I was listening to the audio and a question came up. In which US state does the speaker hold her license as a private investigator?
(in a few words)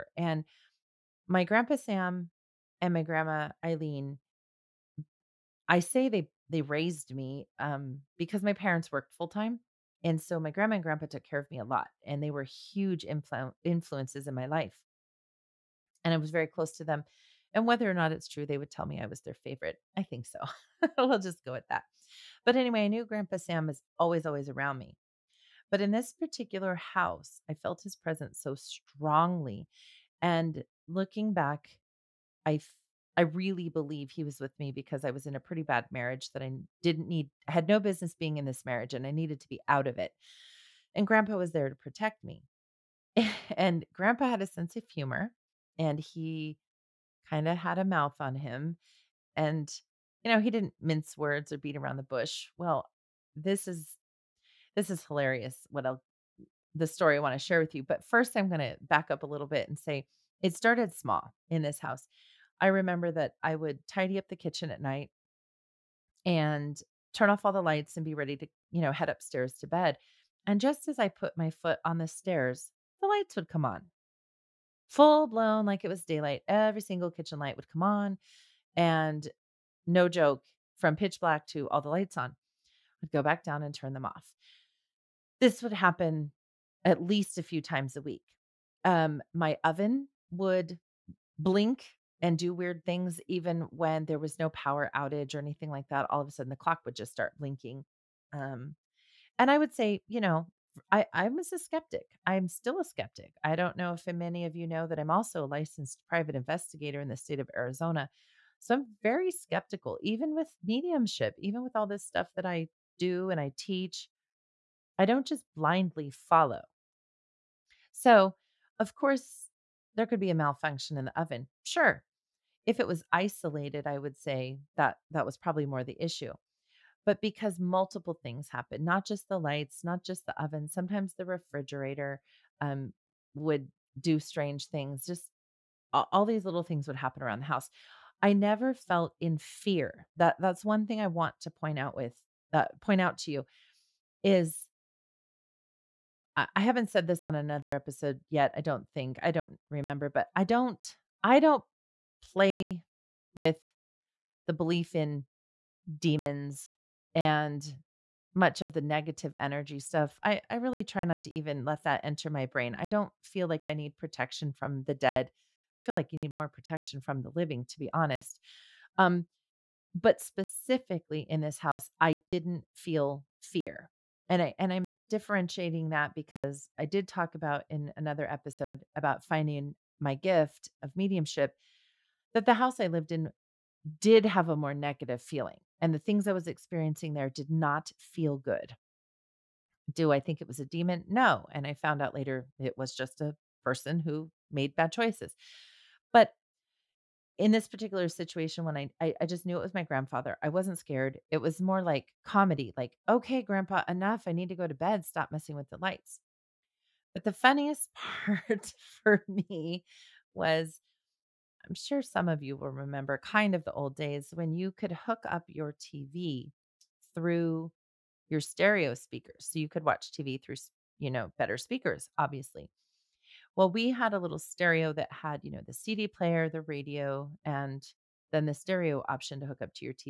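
Arizona.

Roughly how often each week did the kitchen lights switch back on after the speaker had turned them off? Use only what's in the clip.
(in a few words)
a few times.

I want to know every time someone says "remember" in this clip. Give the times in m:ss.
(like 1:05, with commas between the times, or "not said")
1:02, 2:29, 3:32.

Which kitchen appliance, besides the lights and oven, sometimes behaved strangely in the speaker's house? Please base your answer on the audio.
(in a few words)
refrigerator.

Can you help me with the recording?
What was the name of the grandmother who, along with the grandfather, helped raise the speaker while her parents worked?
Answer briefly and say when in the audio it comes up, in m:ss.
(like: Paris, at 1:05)
Eileen, at 0:03.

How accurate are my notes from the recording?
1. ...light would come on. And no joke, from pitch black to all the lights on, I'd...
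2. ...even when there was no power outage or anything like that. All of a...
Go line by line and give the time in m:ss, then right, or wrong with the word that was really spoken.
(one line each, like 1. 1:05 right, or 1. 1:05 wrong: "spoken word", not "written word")
1. 1:17 right
2. 1:33 right.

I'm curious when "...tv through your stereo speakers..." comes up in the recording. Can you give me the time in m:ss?
3:35.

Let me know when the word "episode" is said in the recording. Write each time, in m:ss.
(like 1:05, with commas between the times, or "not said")
2:27, 2:58.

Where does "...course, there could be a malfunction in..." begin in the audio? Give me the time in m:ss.
1:58.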